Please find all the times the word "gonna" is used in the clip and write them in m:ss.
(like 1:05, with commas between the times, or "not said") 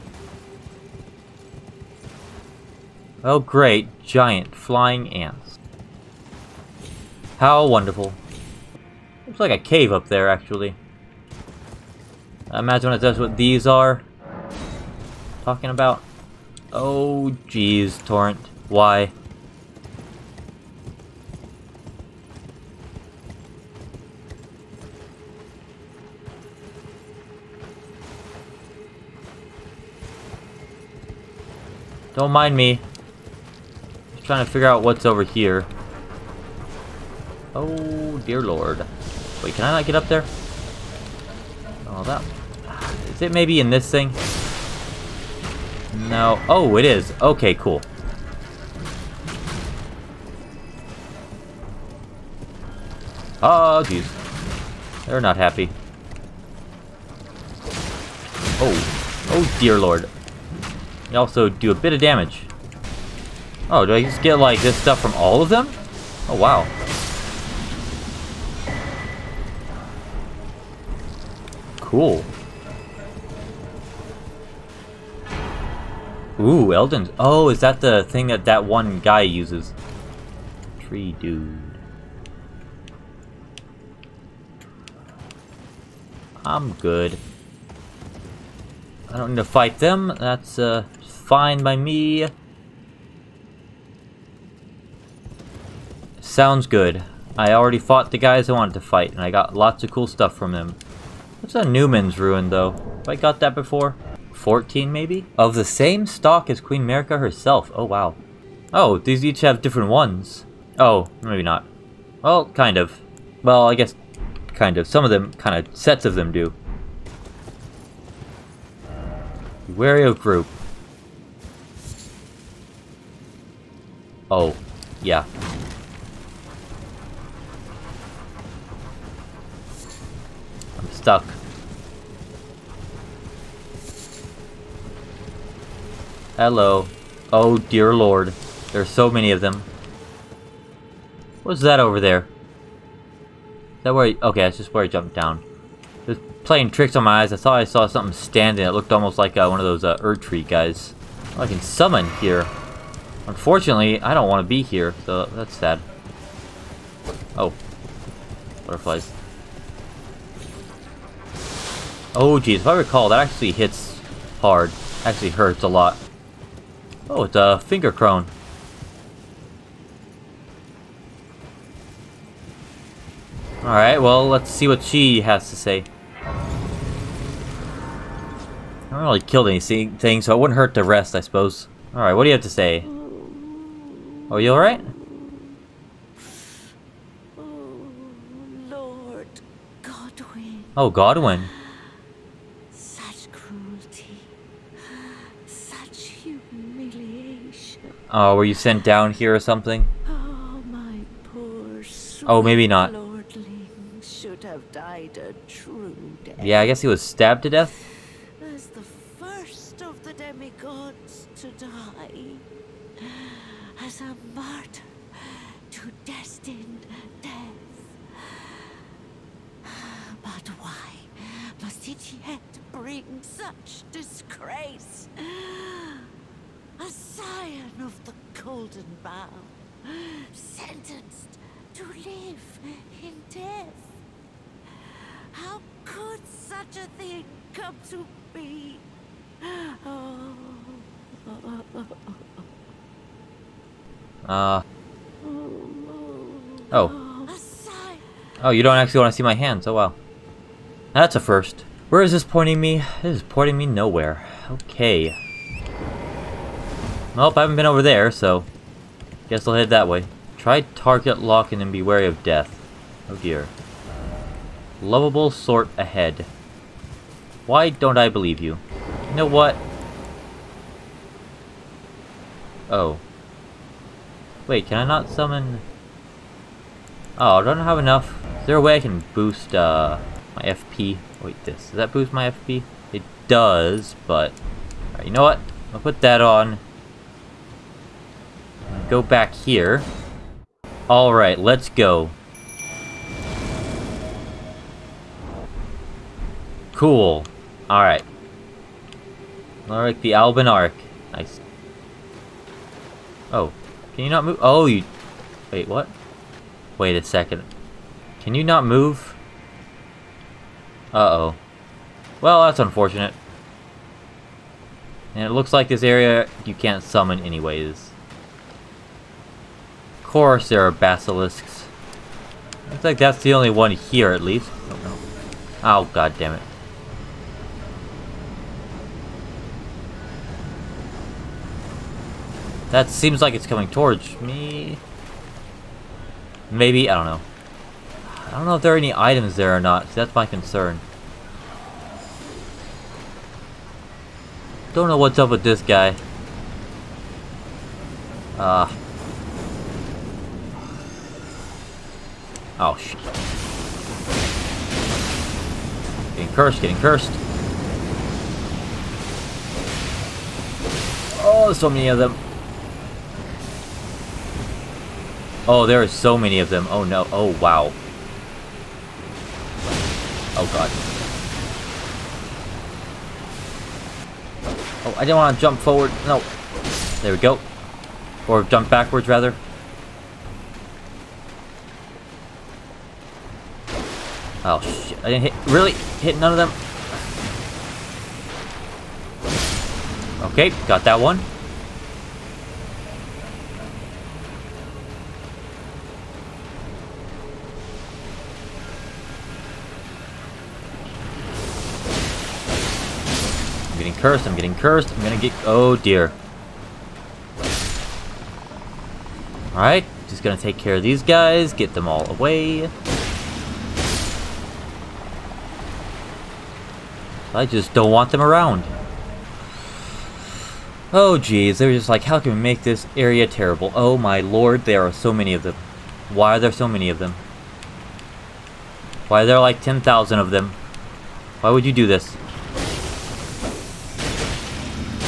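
6:45, 6:50.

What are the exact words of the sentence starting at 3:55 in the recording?
How could such a thing come to be?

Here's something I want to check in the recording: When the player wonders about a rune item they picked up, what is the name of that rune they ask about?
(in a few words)
Numen's Rune.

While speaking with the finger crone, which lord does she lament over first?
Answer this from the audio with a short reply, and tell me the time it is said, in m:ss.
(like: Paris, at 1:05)
Lord Godwyn, at 3:08.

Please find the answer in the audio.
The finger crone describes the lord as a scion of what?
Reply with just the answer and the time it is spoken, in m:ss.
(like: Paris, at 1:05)
the Golden Bough, at 3:48.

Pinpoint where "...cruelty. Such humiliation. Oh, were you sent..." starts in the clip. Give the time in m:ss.
3:13.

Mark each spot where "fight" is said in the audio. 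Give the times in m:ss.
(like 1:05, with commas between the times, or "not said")
1:29, 1:38.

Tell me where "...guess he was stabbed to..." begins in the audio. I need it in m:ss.
3:26.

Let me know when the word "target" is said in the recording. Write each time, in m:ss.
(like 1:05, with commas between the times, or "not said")
4:20.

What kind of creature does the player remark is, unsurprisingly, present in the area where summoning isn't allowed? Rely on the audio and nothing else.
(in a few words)
basilisks.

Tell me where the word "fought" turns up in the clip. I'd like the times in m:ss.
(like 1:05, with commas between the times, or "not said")
1:37.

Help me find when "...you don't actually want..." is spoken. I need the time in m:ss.
4:08.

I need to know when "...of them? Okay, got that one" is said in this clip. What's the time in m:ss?
6:26.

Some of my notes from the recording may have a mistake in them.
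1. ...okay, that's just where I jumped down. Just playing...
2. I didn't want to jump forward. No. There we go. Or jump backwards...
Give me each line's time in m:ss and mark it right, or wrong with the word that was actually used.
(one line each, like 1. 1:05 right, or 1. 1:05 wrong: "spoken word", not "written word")
1. 2:24 right
2. 6:14 right.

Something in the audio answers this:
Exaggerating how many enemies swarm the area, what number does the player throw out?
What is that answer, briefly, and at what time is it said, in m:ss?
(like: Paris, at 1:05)
10,000, at 7:09.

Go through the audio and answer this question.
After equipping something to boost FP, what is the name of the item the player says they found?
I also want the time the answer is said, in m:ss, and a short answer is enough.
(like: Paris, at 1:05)
the Alban Arc, at 5:00.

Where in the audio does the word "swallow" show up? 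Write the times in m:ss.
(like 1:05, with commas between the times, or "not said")
not said.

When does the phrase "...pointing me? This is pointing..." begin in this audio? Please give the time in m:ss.
4:12.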